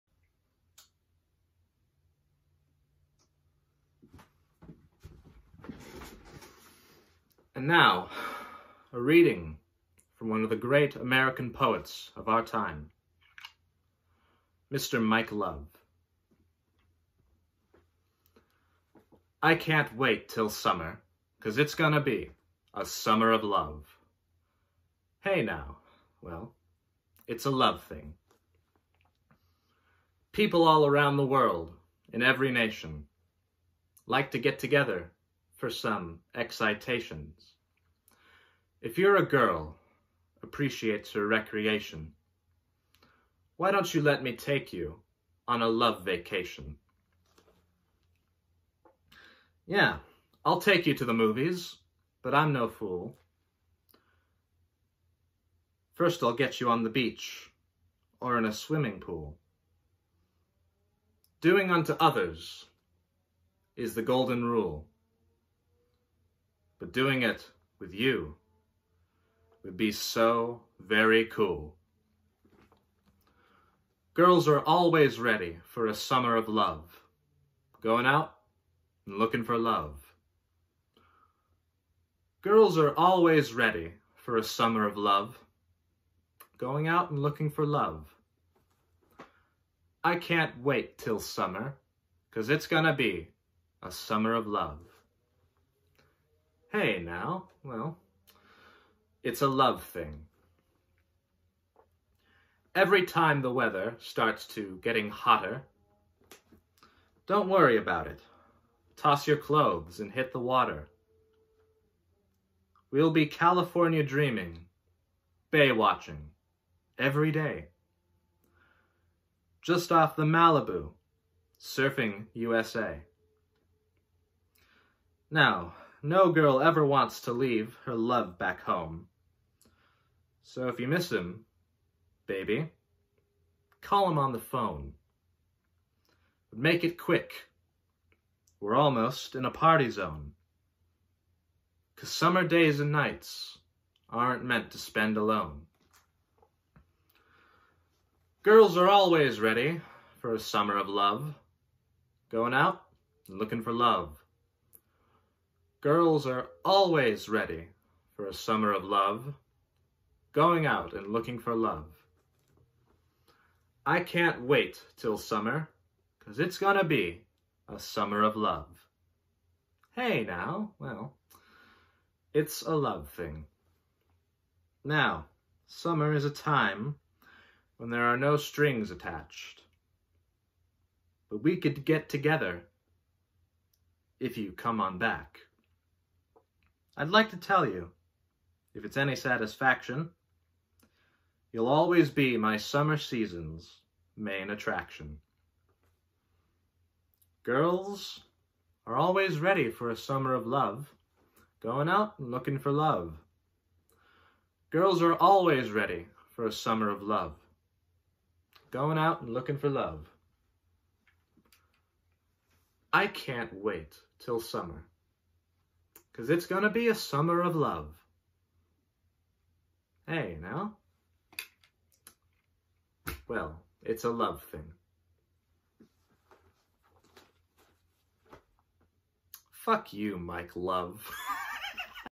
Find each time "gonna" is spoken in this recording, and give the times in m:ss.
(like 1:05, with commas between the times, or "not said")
0:21, 1:32, 2:46.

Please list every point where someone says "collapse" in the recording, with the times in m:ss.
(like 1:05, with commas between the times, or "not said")
not said.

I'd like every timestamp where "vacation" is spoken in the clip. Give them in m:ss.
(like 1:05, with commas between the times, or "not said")
0:46.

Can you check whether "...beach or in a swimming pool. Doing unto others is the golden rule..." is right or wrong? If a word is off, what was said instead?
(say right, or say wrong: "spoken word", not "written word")
right.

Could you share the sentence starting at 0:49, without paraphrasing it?
Yeah, I'll take you to the movies, but I'm no fool.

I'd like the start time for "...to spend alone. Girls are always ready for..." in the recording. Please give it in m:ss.
2:24.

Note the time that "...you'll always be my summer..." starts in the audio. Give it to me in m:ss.
3:11.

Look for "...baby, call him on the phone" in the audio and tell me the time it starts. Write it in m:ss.
2:12.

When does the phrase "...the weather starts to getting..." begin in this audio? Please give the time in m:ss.
1:43.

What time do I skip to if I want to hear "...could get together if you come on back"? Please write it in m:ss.
3:01.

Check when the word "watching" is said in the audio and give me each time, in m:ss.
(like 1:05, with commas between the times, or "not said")
1:55.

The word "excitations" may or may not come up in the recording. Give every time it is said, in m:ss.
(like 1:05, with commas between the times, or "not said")
0:36.